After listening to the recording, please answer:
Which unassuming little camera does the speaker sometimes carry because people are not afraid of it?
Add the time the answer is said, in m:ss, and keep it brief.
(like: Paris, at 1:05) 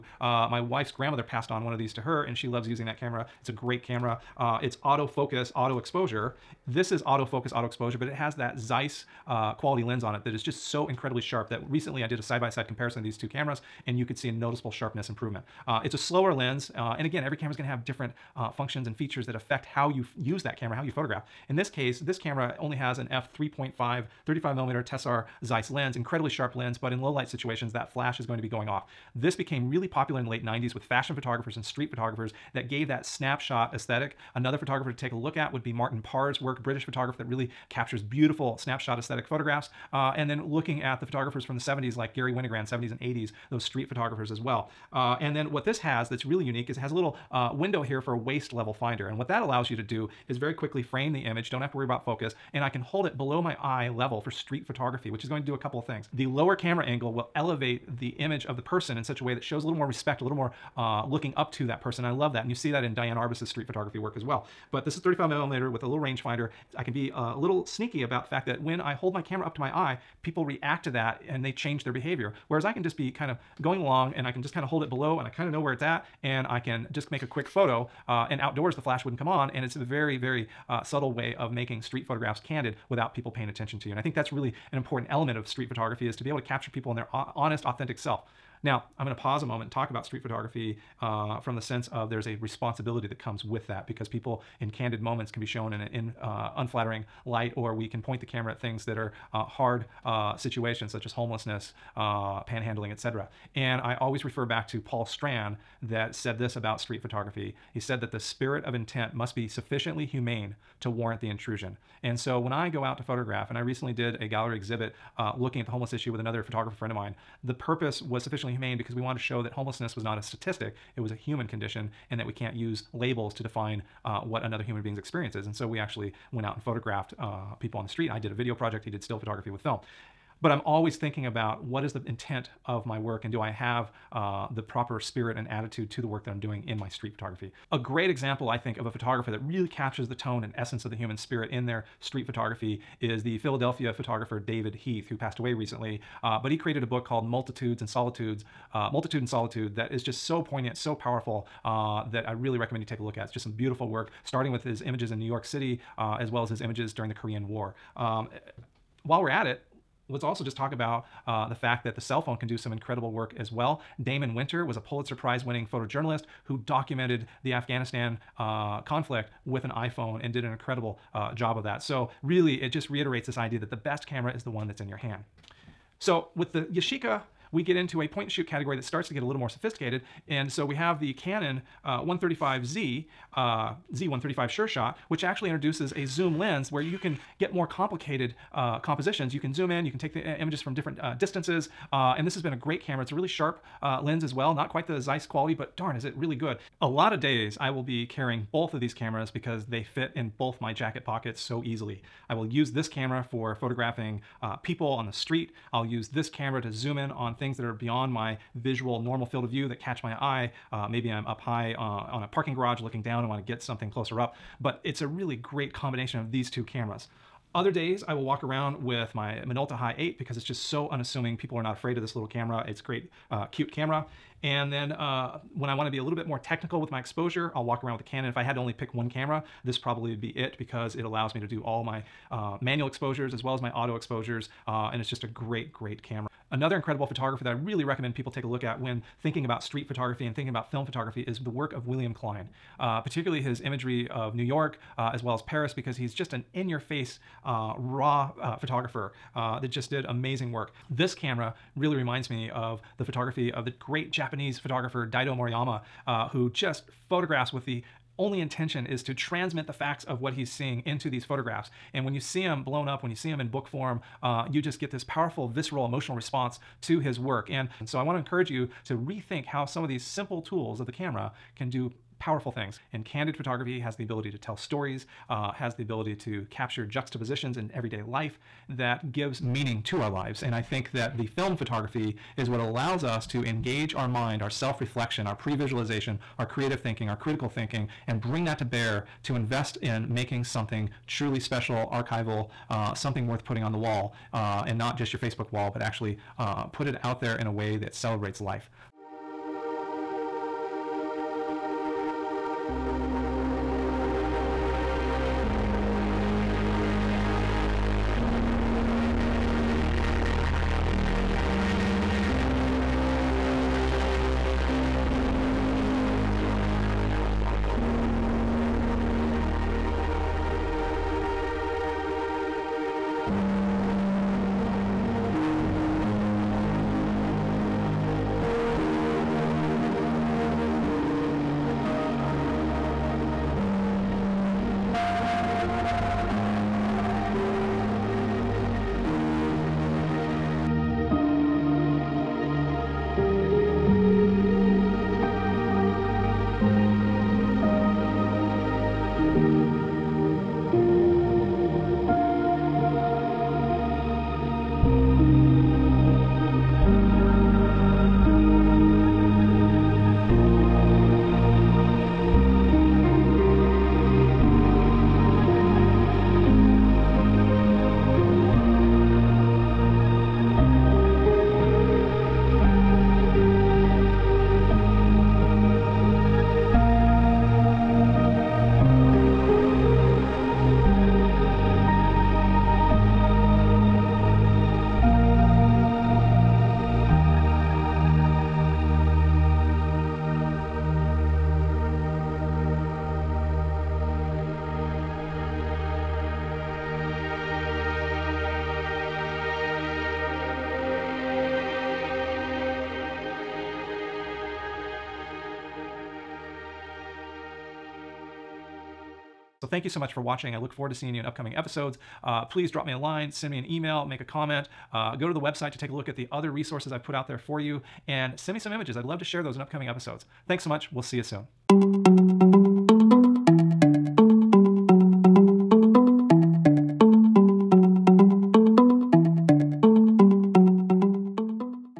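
Minolta High 8, at 3:39.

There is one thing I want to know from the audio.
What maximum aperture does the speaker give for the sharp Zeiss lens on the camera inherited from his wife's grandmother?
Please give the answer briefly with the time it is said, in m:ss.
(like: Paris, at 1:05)
f3.5, at 0:23.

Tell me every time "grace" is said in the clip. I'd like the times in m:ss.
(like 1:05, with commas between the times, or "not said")
not said.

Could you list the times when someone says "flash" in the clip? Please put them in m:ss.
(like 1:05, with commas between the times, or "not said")
0:27, 1:18.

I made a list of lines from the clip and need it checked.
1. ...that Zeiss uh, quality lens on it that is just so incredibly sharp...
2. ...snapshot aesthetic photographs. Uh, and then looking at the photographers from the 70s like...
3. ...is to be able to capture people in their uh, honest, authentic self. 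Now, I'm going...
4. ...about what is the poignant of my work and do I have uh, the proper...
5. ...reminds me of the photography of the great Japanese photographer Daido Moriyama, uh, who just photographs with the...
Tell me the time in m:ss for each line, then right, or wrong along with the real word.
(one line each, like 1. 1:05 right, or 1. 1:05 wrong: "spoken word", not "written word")
1. 0:08 right
2. 0:38 right
3. 1:26 right
4. 2:11 wrong: "intent", not "poignant"
5. 4:11 right.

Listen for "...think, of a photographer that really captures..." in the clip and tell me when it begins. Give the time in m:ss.
2:18.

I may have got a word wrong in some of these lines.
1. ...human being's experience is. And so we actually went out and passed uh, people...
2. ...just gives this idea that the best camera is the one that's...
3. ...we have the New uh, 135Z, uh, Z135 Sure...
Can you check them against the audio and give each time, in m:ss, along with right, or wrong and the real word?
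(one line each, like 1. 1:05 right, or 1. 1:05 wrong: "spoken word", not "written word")
1. 2:04 wrong: "photographed", not "passed"
2. 2:52 wrong: "reiterates", not "gives"
3. 3:00 wrong: "Canon", not "New".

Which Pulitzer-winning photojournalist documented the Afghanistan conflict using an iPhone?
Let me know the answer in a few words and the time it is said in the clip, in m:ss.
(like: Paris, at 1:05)
Damon Winter, at 2:44.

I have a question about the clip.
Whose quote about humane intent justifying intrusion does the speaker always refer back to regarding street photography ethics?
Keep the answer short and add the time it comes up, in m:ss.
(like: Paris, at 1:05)
Paul Strand, at 1:44.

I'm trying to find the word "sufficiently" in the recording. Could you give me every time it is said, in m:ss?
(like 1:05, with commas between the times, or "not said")
1:49, 1:58.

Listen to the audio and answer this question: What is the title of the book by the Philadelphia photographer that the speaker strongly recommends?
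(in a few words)
Multitude and Solitude.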